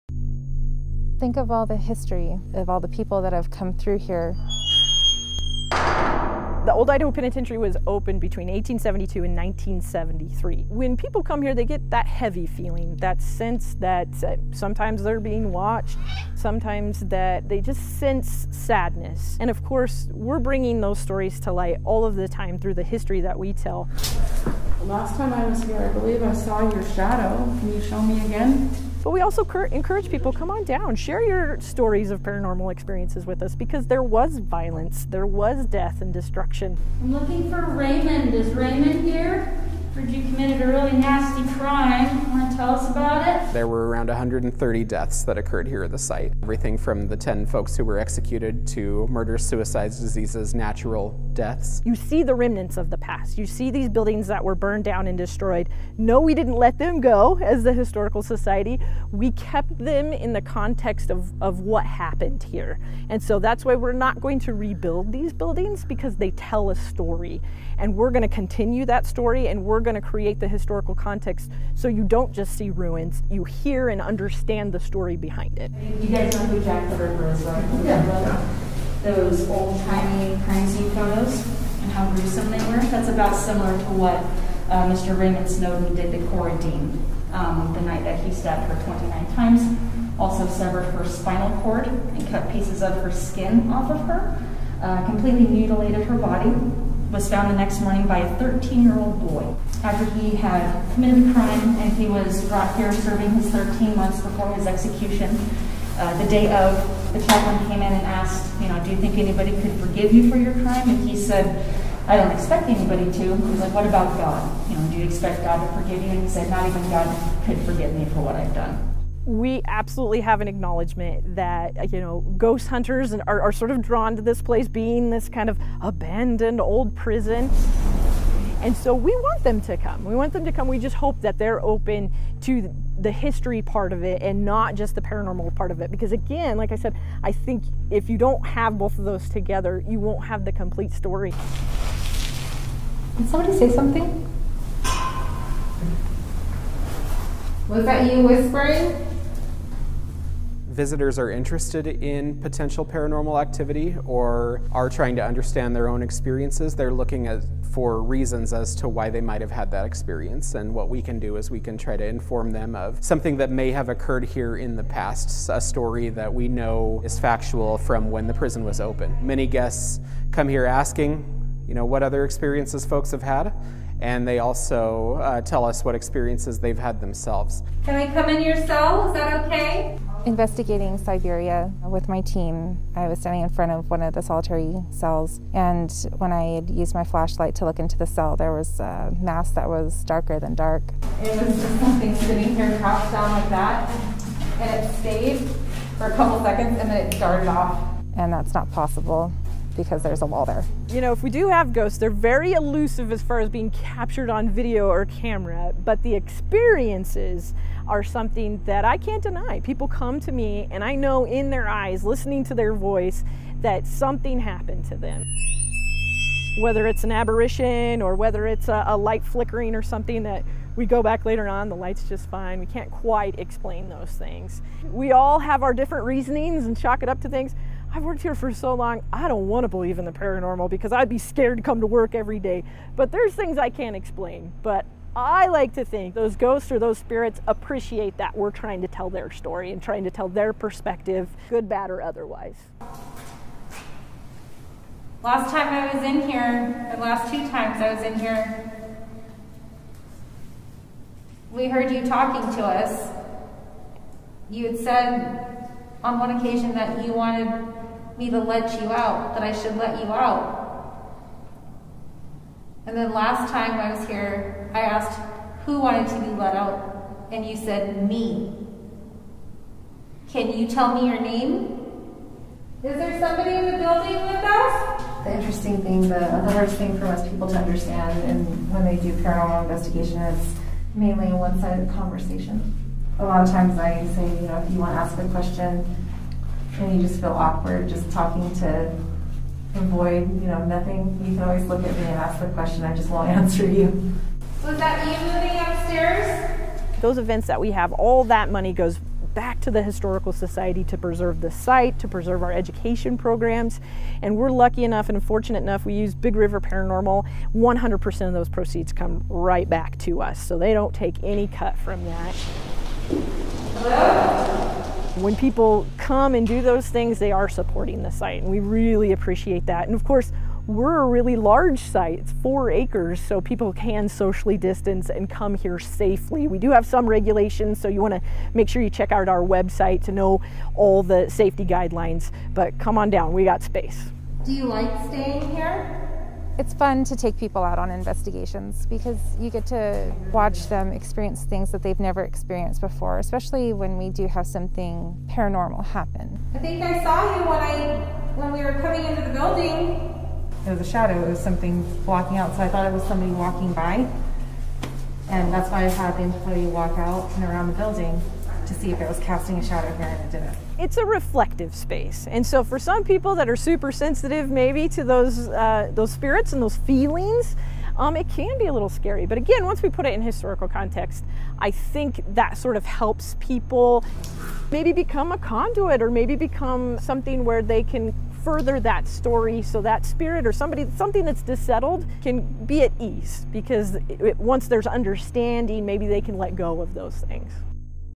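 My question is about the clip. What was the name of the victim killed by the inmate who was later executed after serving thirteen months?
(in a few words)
Cora Dean.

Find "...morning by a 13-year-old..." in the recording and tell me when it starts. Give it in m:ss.
1:37.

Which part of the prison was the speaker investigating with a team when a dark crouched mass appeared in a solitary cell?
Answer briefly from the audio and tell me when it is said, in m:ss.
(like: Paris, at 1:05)
Siberia, at 3:00.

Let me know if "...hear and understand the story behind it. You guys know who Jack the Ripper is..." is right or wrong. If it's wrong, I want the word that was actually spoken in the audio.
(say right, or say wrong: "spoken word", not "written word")
right.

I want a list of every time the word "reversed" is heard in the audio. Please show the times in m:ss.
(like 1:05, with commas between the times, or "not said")
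not said.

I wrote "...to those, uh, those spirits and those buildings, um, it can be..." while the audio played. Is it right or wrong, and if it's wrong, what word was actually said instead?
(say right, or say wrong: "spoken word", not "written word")
wrong: "feelings", not "buildings".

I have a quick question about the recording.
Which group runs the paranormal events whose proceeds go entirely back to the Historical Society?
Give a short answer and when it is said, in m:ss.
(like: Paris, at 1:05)
Big River Paranormal, at 5:06.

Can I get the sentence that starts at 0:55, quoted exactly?
No, we didn't let them go as the Historical Society.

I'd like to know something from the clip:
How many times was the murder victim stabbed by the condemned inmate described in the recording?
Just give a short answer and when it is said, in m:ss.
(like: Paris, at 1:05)
29, at 1:28.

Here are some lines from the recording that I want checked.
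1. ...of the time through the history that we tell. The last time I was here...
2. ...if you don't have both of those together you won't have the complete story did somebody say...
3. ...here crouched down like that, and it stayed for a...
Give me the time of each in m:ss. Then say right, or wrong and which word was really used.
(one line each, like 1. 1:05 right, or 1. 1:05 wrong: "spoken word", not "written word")
1. 0:22 right
2. 2:17 right
3. 3:12 right.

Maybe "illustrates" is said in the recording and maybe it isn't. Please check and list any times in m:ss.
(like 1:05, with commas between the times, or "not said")
not said.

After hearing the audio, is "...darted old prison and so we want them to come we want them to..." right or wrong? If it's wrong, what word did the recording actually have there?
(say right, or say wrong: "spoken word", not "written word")
wrong: "abandoned", not "darted".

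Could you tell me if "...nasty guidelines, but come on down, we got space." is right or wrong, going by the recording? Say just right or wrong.
wrong.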